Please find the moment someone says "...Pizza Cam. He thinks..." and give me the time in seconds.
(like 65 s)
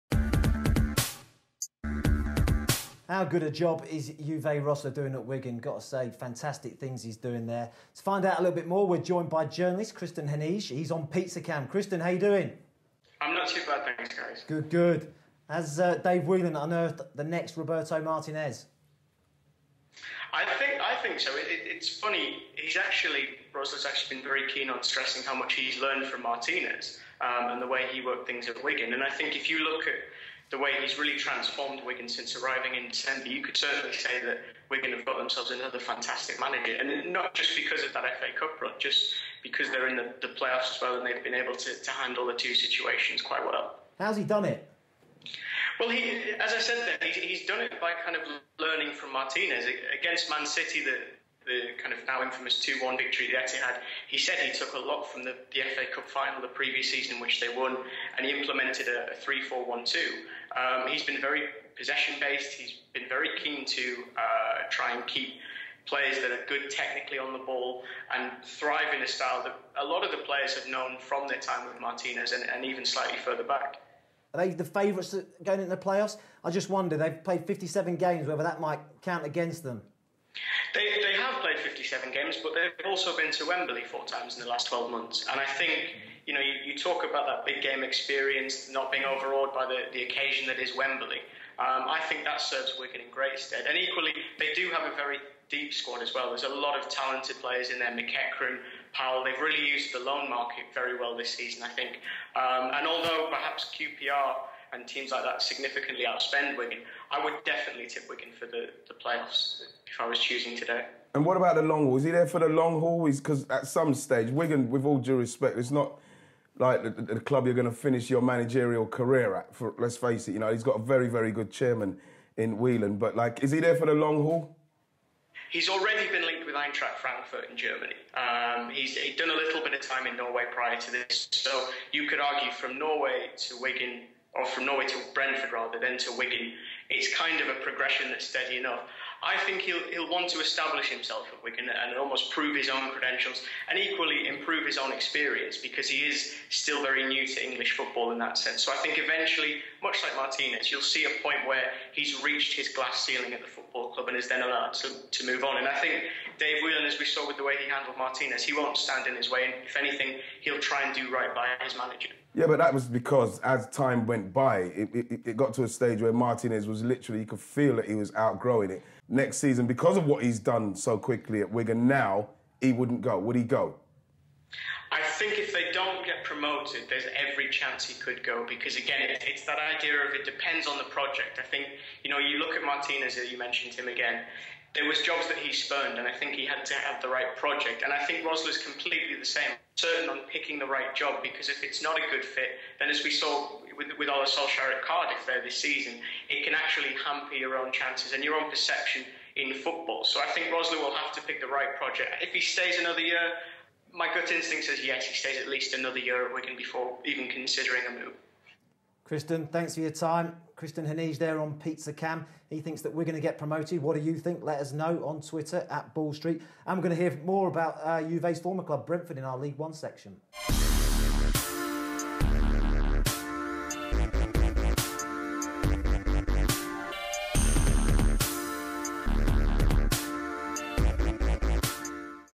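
211 s.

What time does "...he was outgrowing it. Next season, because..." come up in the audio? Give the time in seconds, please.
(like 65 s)
167 s.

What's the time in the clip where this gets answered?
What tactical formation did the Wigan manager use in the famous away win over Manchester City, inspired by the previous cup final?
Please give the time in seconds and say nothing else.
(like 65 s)
59 s.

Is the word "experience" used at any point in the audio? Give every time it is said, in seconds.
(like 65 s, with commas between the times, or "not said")
87 s, 144 s.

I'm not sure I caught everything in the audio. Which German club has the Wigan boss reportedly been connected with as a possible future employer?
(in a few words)
Eintracht Frankfurt.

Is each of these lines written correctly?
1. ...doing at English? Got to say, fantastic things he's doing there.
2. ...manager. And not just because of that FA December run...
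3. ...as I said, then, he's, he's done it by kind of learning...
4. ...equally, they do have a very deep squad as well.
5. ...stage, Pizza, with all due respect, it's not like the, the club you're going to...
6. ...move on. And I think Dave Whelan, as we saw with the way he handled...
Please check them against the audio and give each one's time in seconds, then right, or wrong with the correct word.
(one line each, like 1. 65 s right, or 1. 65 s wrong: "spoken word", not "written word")
1. 4 s wrong: "Wigan", not "English"
2. 36 s wrong: "Cup", not "December"
3. 46 s right
4. 93 s right
5. 113 s wrong: "Wigan", not "Pizza"
6. 155 s right.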